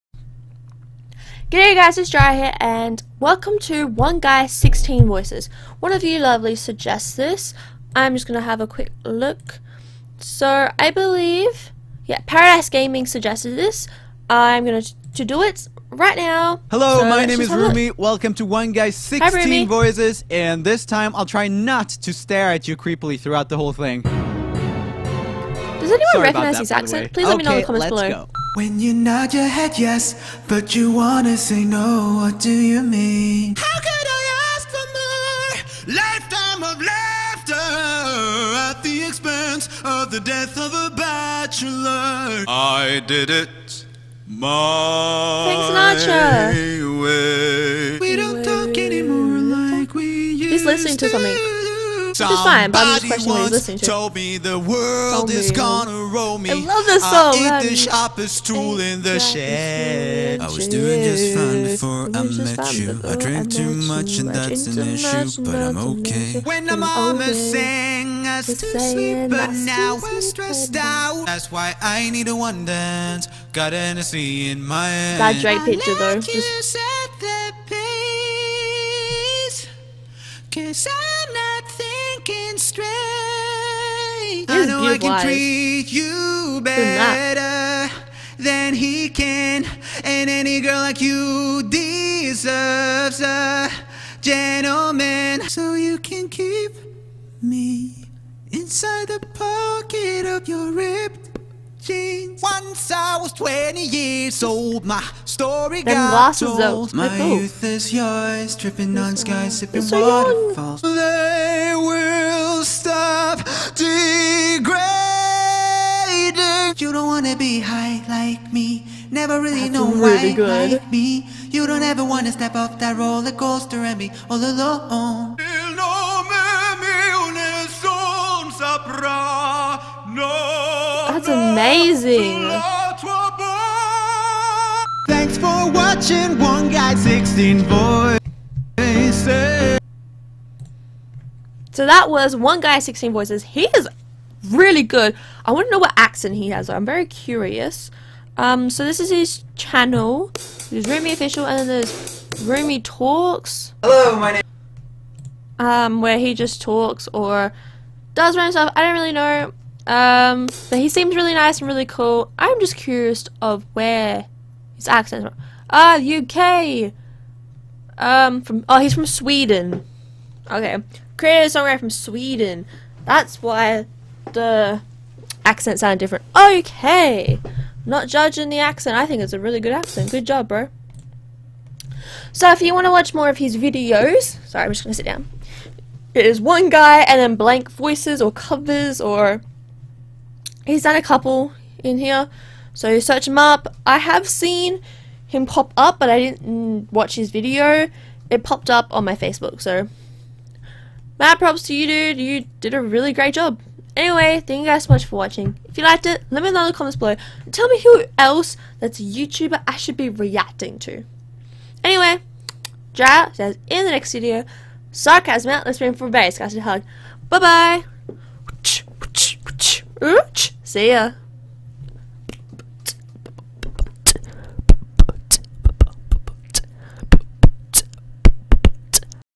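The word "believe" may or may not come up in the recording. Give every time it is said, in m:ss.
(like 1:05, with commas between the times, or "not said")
0:10.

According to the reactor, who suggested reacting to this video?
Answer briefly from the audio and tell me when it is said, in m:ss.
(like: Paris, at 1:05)
Paradise Gaming, at 0:12.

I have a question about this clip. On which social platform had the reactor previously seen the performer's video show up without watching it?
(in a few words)
Facebook.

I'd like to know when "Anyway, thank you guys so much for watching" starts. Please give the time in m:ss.
3:23.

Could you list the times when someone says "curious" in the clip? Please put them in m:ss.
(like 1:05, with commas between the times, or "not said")
2:27, 2:42.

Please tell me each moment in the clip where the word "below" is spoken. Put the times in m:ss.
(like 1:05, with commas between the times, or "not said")
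0:27, 3:26.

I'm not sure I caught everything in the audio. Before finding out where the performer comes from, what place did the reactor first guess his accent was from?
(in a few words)
UK.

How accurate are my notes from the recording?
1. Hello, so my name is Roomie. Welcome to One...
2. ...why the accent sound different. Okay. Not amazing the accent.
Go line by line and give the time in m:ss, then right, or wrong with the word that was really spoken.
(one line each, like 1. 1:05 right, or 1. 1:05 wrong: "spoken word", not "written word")
1. 0:16 right
2. 2:53 wrong: "judging", not "amazing".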